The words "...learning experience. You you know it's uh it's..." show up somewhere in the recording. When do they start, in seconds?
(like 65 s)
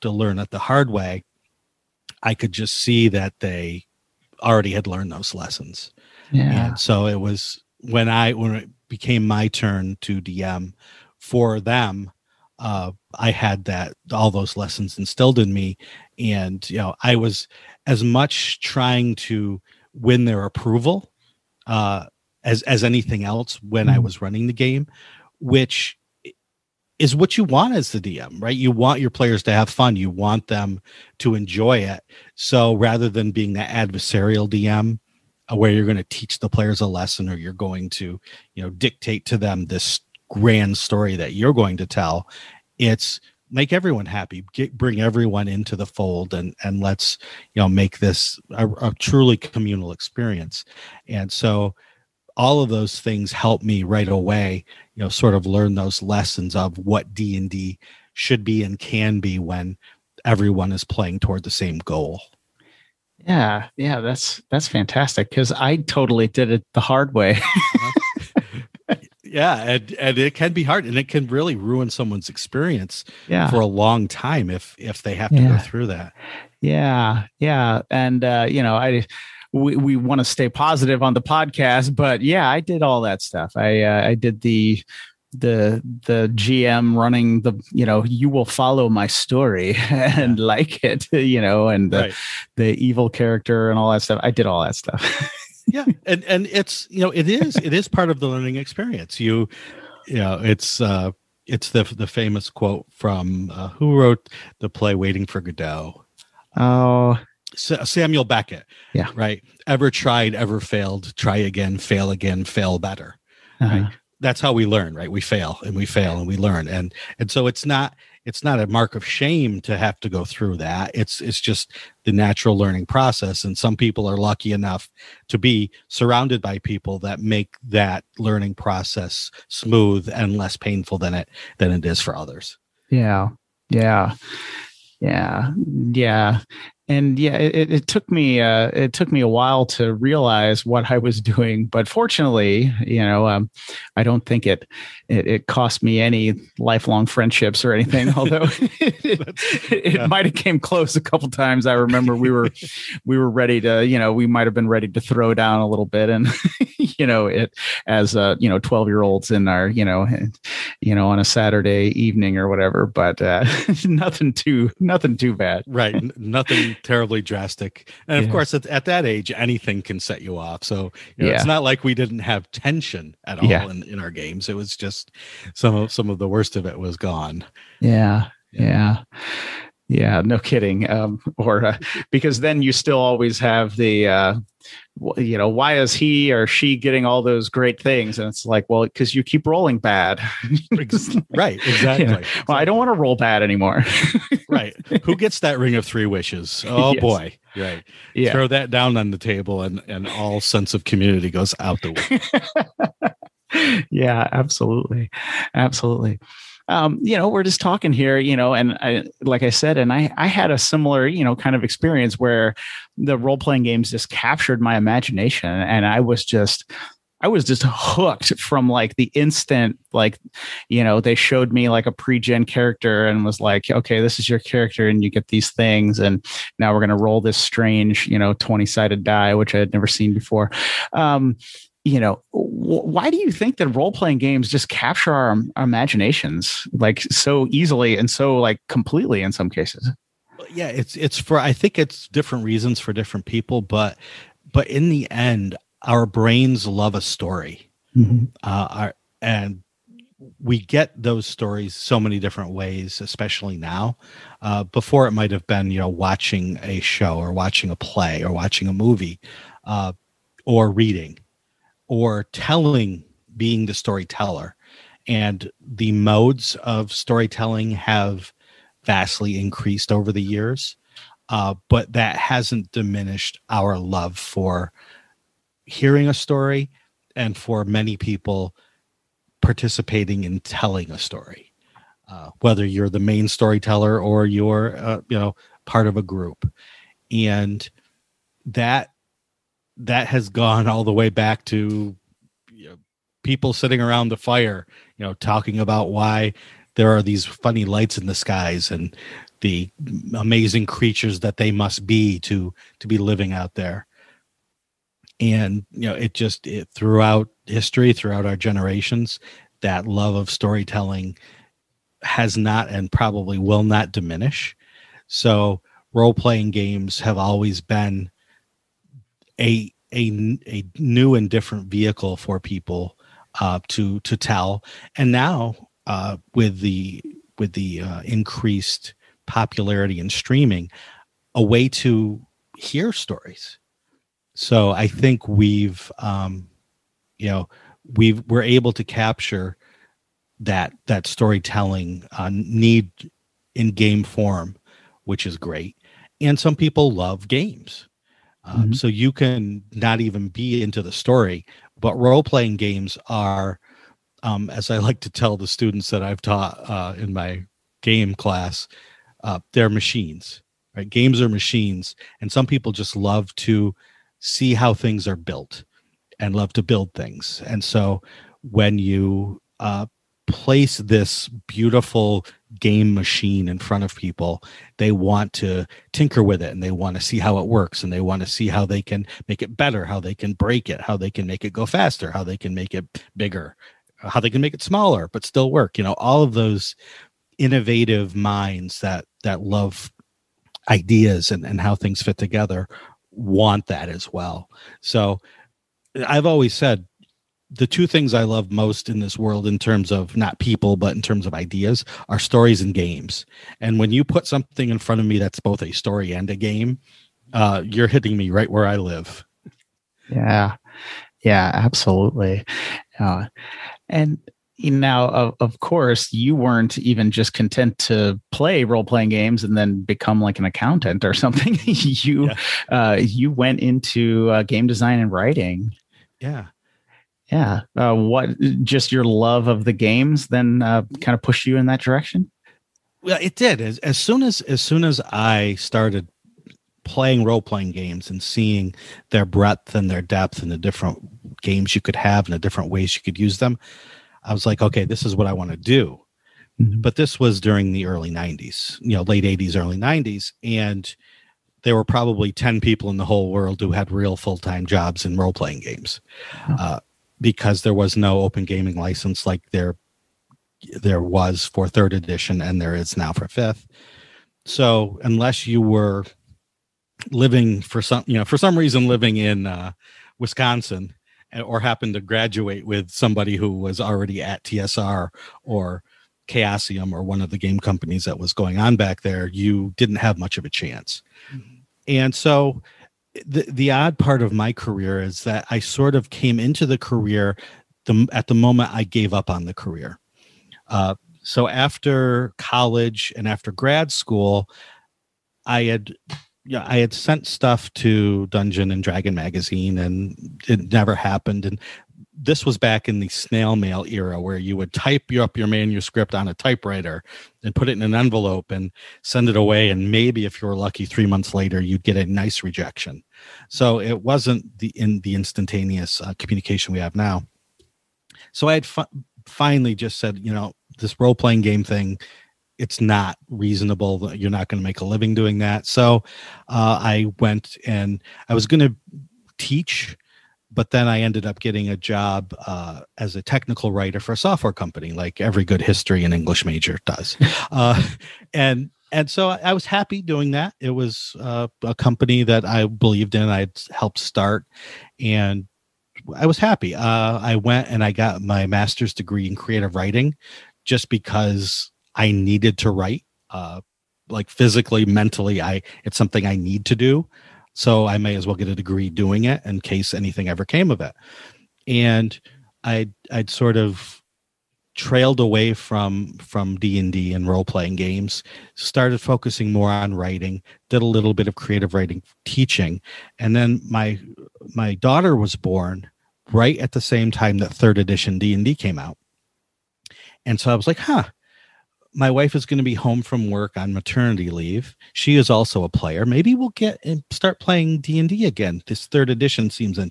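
98 s.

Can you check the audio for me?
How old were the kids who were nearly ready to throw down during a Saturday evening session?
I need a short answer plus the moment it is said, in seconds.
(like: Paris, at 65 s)
12, at 158 s.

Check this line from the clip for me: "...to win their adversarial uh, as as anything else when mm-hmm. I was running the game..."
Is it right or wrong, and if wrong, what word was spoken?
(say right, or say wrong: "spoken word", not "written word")
wrong: "approval", not "adversarial".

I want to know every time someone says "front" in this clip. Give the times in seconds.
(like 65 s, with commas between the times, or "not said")
373 s, 404 s.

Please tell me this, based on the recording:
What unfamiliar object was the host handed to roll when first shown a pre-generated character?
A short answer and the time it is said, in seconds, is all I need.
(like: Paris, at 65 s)
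20-sided die, at 228 s.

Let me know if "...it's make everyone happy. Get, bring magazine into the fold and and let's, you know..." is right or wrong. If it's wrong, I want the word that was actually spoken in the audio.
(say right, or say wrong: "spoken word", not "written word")
wrong: "everyone", not "magazine".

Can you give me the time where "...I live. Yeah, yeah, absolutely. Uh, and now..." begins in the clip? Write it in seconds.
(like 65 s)
408 s.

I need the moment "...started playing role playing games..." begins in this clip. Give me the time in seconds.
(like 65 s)
435 s.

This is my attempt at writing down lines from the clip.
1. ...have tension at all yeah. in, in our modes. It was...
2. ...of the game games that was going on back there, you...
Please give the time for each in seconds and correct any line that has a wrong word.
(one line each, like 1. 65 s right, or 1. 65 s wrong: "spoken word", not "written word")
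1. 172 s wrong: "games", not "modes"
2. 477 s wrong: "companies", not "games".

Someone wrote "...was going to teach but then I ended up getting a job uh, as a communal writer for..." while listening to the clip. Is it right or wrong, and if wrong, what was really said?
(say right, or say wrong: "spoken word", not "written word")
wrong: "technical", not "communal".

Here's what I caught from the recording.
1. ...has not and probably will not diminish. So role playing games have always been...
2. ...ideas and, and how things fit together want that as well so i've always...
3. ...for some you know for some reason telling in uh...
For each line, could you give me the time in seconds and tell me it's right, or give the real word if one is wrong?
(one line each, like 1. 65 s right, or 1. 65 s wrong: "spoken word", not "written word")
1. 312 s right
2. 390 s right
3. 467 s wrong: "living", not "telling".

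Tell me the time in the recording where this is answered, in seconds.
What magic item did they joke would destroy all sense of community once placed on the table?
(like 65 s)
195 s.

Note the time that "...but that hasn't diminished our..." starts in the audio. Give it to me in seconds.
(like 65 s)
271 s.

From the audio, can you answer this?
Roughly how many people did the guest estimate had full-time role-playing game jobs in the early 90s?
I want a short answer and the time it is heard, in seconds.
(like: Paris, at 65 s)
10, at 452 s.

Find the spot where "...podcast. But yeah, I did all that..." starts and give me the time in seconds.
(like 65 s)
81 s.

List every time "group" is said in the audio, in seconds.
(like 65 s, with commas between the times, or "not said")
286 s.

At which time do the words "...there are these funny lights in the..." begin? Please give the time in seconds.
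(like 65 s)
296 s.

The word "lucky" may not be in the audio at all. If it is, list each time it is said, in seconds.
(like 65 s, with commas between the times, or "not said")
124 s, 510 s.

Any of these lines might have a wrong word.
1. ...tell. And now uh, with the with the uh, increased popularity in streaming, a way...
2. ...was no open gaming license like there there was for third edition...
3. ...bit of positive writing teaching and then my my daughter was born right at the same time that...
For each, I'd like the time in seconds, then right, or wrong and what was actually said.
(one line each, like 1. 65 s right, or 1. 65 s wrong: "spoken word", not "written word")
1. 324 s right
2. 457 s right
3. 571 s wrong: "creative", not "positive".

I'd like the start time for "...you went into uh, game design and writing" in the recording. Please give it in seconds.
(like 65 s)
422 s.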